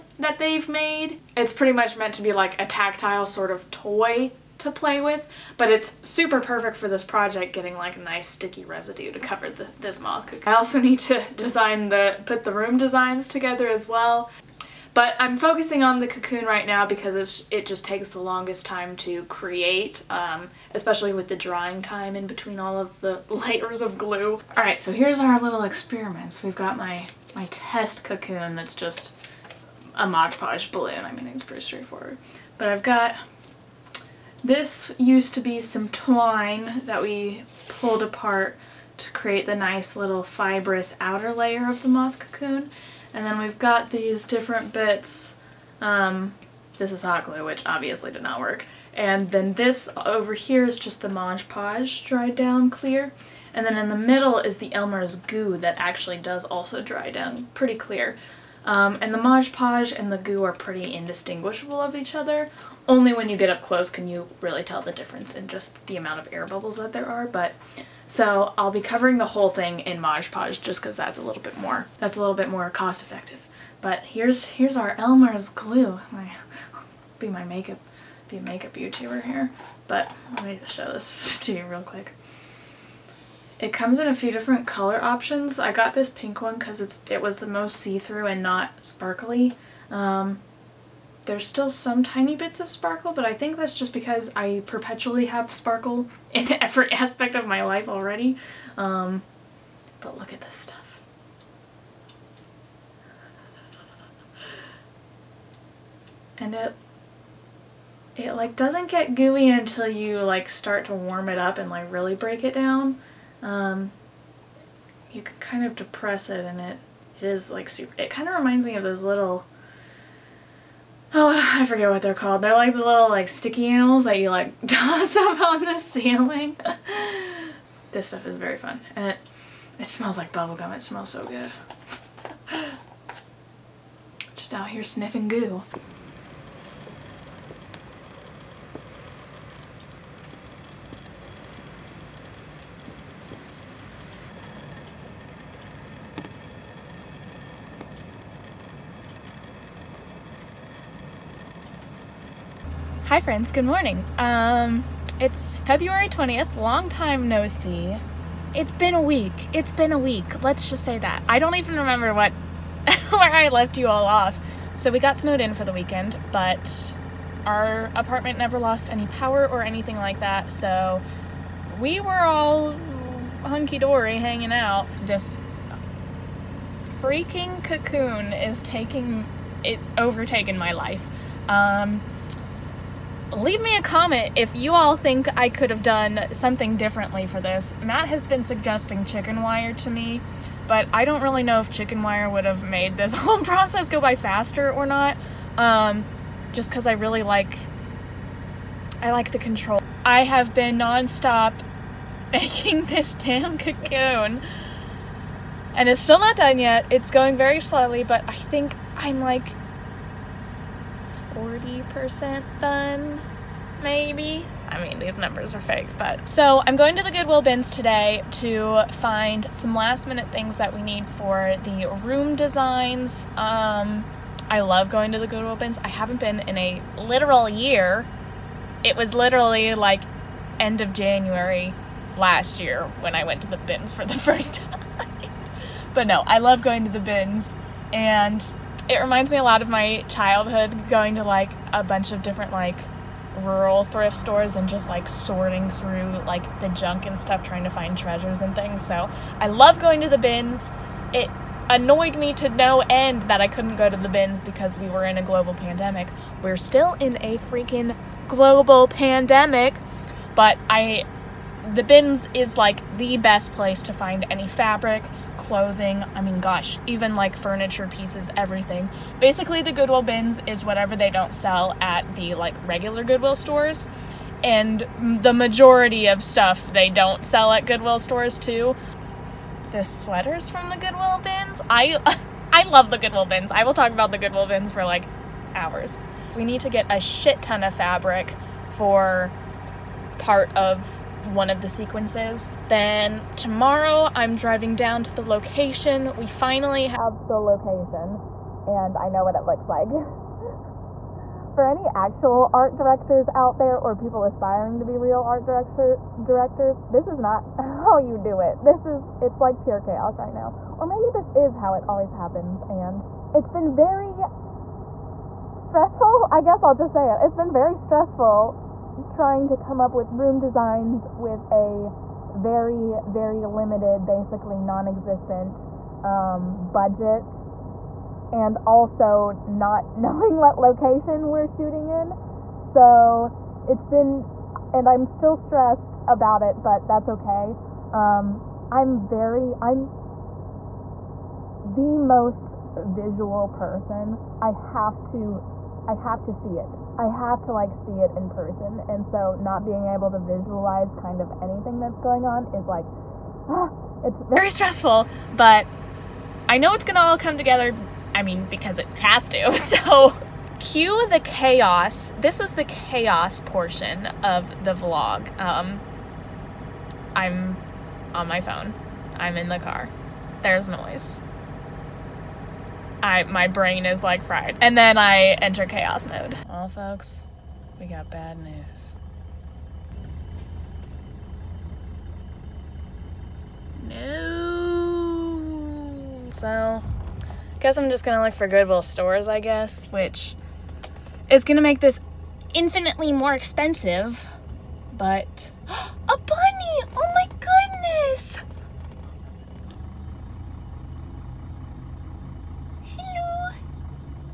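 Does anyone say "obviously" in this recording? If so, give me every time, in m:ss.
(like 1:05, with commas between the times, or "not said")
0:47.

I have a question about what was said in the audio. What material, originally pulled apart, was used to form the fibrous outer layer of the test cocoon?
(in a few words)
twine.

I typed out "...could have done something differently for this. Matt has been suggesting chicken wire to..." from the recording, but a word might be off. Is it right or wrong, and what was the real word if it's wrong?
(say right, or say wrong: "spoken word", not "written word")
right.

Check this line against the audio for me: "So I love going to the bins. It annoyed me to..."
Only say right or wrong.
right.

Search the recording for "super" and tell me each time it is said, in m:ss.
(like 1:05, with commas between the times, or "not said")
0:06, 1:57.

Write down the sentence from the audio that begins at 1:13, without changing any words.
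But here's, here's our Elmer's glue.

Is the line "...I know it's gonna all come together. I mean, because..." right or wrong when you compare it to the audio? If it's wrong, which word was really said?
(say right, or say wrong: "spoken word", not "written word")
right.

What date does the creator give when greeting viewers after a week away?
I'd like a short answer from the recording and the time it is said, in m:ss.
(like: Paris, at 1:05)
February 20th, at 2:35.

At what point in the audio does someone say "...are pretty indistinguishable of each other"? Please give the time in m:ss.
1:00.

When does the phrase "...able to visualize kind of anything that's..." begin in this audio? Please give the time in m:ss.
5:49.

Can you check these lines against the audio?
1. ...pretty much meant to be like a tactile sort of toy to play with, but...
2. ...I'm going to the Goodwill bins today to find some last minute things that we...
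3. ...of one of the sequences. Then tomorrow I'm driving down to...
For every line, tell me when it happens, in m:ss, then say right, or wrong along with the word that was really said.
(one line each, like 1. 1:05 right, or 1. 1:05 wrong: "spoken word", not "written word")
1. 0:01 right
2. 3:36 right
3. 4:50 right.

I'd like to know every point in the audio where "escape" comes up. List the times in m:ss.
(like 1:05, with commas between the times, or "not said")
not said.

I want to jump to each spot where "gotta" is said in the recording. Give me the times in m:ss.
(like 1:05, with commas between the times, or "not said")
not said.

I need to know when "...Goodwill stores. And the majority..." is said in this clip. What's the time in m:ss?
4:33.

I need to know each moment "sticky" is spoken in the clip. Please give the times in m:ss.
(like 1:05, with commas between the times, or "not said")
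0:08, 2:03.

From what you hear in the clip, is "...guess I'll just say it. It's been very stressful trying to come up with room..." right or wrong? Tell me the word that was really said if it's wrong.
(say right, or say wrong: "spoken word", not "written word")
right.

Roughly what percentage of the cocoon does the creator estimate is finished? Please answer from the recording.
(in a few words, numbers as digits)
40%.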